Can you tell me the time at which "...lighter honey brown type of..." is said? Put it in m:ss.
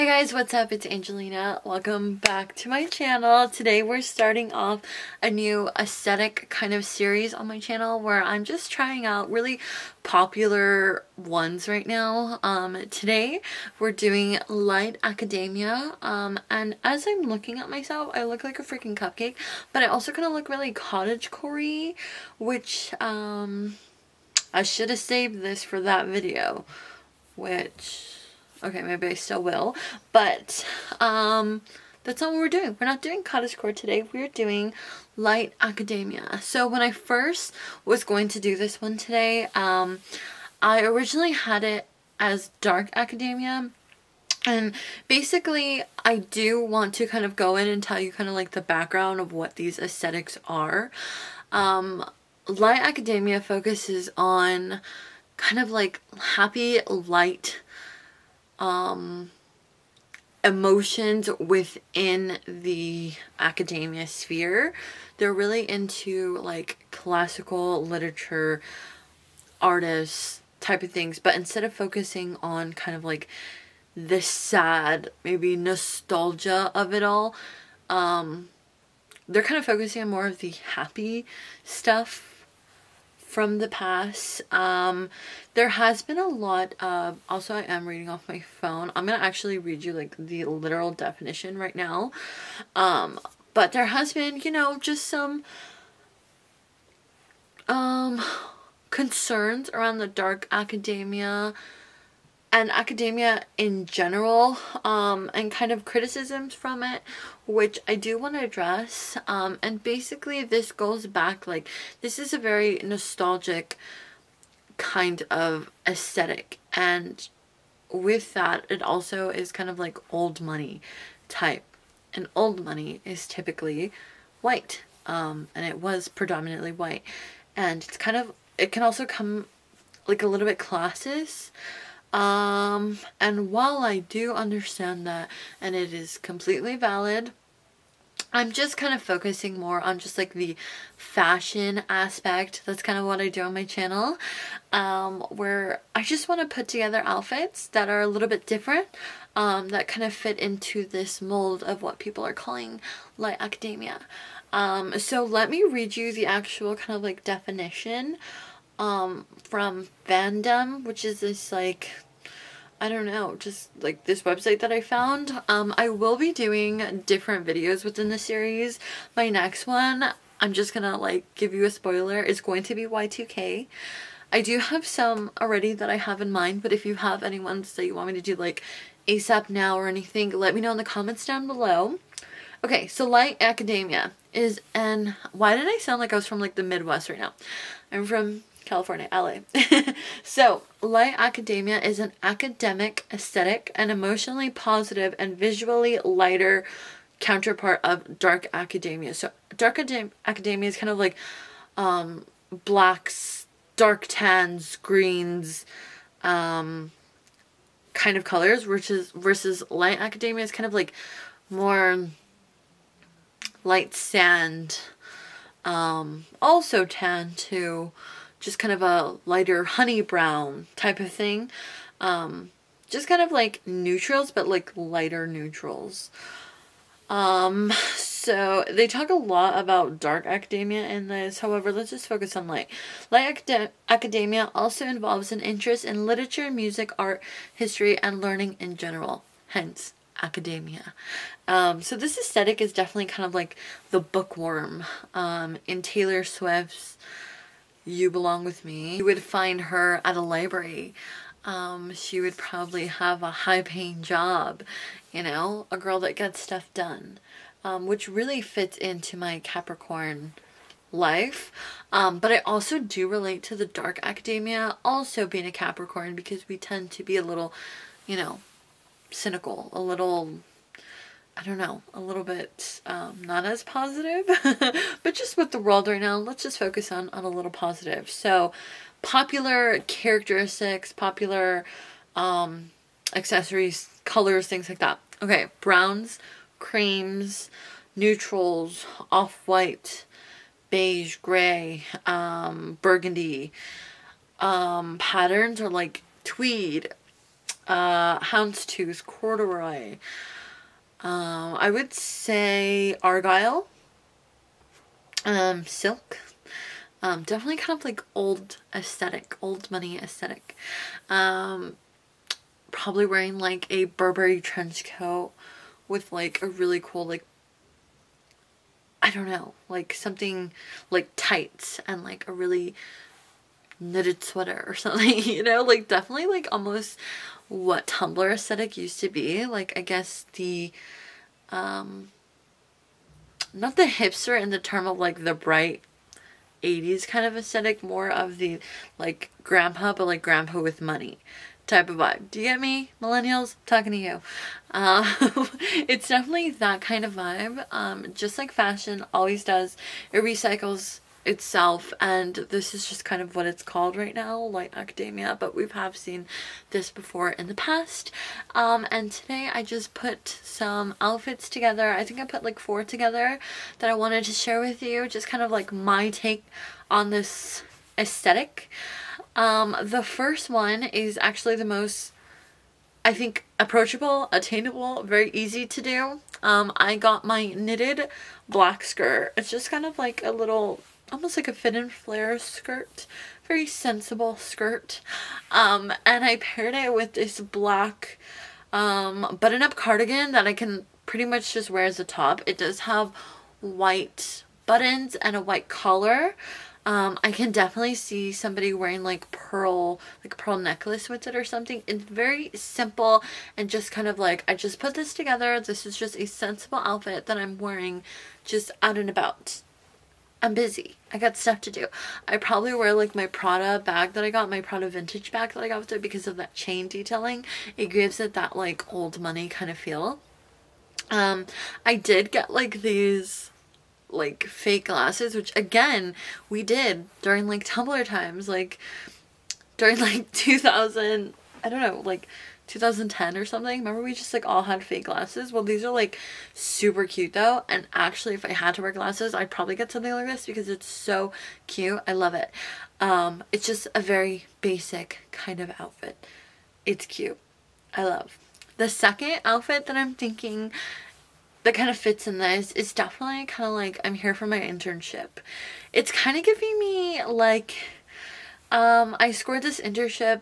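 3:39.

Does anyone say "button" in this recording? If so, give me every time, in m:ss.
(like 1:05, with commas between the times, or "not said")
6:29, 6:34.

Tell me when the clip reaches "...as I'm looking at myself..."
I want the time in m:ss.
0:16.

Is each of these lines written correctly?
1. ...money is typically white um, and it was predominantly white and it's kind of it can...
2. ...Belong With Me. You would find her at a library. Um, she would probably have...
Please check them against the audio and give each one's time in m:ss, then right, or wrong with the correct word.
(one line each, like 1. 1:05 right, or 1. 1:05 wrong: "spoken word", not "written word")
1. 2:02 right
2. 4:08 right.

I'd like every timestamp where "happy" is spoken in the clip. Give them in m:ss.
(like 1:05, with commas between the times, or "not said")
0:56, 1:20.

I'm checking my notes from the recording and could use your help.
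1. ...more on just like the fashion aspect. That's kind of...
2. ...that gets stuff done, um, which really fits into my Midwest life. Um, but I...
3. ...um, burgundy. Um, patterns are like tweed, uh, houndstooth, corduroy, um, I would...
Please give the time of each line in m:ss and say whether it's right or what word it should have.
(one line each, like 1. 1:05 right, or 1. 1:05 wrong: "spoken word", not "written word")
1. 2:19 right
2. 4:16 wrong: "Capricorn", not "Midwest"
3. 4:52 right.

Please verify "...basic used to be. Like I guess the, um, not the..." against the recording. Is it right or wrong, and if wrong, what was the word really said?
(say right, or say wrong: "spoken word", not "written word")
wrong: "aesthetic", not "basic".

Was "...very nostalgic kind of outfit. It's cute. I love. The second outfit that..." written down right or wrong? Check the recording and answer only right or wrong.
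wrong.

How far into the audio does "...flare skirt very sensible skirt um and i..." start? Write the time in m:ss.
6:21.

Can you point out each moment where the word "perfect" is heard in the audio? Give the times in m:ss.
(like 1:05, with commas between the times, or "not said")
not said.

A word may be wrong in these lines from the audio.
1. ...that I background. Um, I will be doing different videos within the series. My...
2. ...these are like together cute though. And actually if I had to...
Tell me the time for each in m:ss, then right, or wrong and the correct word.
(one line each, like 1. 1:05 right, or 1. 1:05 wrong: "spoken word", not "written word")
1. 2:44 wrong: "found", not "background"
2. 7:15 wrong: "super", not "together".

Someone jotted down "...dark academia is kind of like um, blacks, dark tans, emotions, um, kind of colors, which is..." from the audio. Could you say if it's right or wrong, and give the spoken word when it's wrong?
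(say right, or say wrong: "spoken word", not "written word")
wrong: "greens", not "emotions".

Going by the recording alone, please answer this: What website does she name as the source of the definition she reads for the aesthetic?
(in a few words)
Fandom.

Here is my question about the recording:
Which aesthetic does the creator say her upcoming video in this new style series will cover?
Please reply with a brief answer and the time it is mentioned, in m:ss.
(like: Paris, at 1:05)
Y2K, at 2:52.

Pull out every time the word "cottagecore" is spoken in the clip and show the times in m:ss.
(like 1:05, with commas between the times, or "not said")
0:20, 0:33.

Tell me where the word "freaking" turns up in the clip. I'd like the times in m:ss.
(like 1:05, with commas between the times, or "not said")
0:18.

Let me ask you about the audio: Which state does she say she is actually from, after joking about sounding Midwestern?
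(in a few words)
California.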